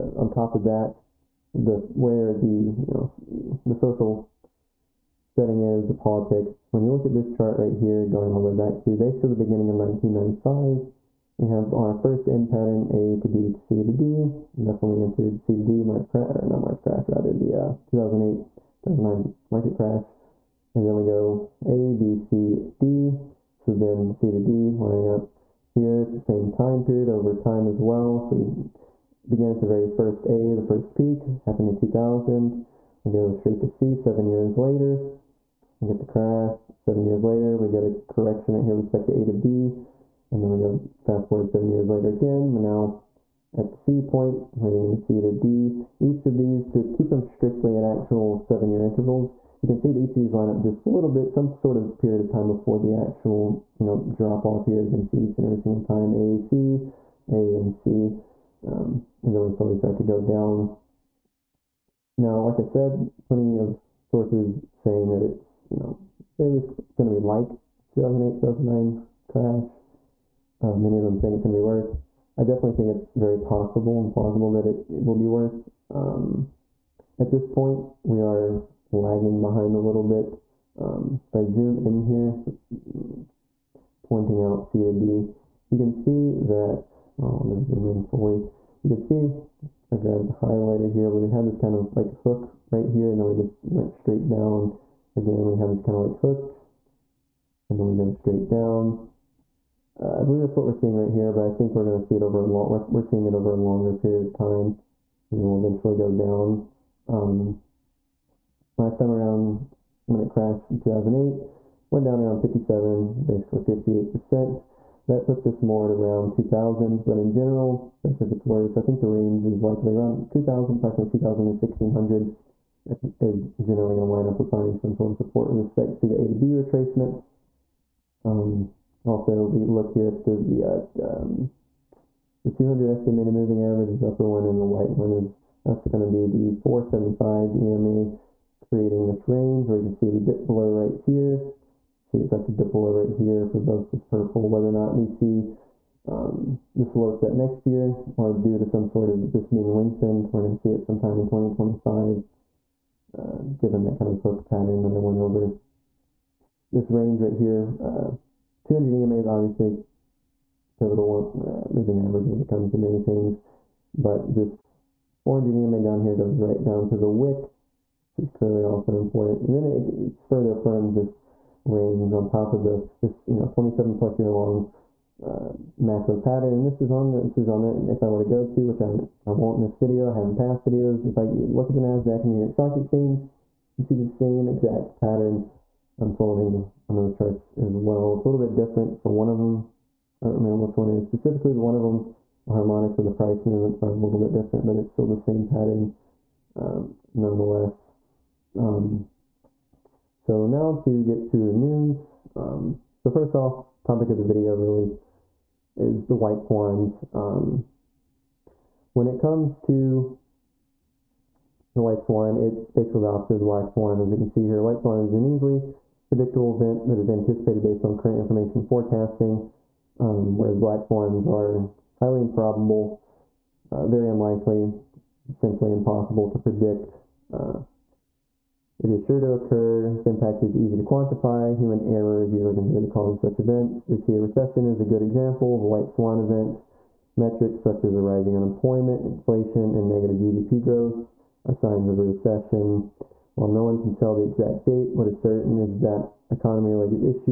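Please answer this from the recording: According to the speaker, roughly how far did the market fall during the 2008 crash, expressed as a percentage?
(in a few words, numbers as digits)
58%.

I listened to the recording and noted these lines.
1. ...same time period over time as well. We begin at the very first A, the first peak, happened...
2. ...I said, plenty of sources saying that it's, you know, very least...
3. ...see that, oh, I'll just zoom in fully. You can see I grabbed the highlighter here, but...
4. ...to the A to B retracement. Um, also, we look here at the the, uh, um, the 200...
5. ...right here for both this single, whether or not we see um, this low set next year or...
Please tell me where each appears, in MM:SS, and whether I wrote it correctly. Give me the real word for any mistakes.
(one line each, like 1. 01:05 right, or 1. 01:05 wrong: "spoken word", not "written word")
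1. 00:26 right
2. 01:02 right
3. 01:25 right
4. 02:06 right
5. 02:22 wrong: "purple", not "single".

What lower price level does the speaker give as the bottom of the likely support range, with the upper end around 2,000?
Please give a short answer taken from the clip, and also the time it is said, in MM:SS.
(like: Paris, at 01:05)
1,600, at 02:01.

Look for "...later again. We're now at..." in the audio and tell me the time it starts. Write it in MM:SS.
00:41.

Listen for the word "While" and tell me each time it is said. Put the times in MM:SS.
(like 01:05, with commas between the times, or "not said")
04:03.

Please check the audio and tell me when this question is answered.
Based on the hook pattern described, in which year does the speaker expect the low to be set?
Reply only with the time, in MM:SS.
02:31.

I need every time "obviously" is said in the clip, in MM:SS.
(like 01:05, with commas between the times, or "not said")
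02:39.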